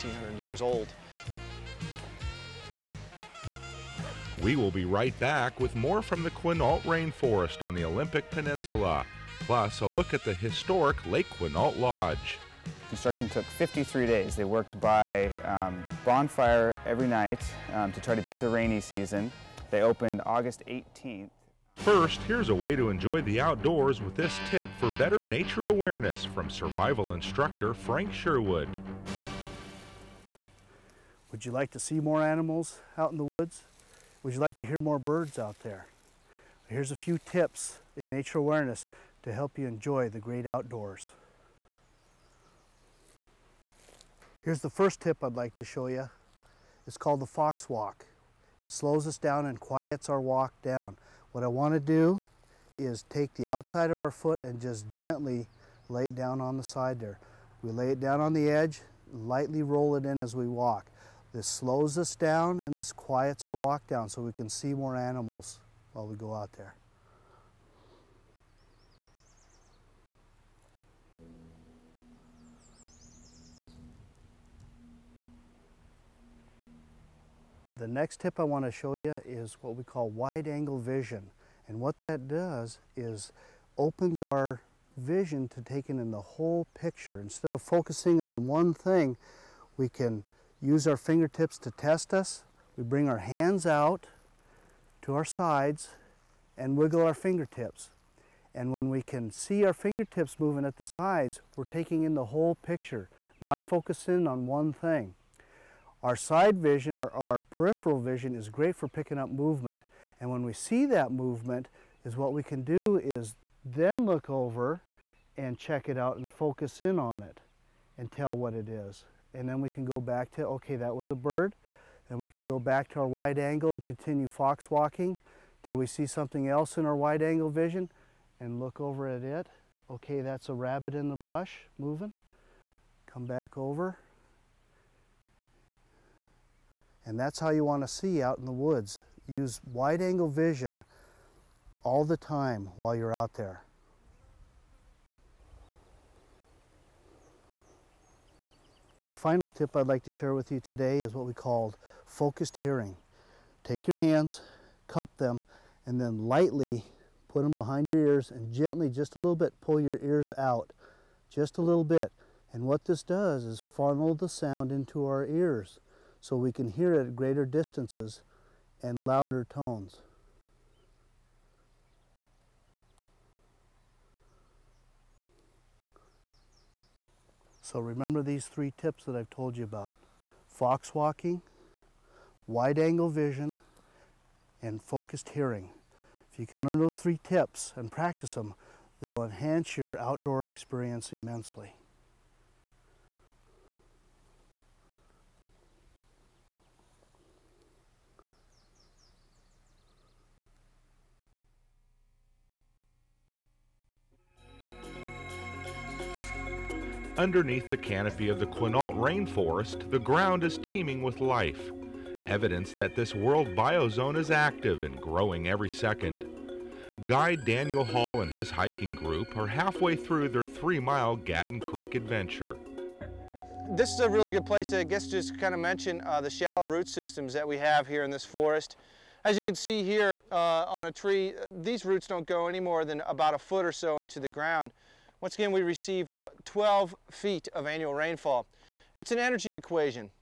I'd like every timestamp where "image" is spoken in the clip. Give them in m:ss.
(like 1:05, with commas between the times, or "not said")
not said.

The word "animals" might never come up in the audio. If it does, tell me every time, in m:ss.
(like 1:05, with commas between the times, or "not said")
0:32, 1:04.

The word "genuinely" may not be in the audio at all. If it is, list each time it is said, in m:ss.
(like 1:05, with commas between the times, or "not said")
not said.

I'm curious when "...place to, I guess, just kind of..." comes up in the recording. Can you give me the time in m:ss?
3:44.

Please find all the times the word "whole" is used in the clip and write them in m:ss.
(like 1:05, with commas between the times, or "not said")
1:26, 1:42.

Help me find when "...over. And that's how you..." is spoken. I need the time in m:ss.
2:13.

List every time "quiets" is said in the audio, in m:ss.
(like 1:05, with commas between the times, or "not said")
0:49, 1:02.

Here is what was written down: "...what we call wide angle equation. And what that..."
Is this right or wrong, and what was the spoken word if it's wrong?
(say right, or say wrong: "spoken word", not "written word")
wrong: "vision", not "equation".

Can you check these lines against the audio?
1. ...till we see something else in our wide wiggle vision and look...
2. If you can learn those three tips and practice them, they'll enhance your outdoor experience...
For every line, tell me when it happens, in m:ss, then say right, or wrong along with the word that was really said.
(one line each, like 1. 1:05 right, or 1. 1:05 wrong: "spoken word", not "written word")
1. 2:05 wrong: "angle", not "wiggle"
2. 3:06 right.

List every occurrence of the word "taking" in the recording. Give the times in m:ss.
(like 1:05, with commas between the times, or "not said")
1:25, 1:41.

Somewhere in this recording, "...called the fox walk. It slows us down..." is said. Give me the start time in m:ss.
0:46.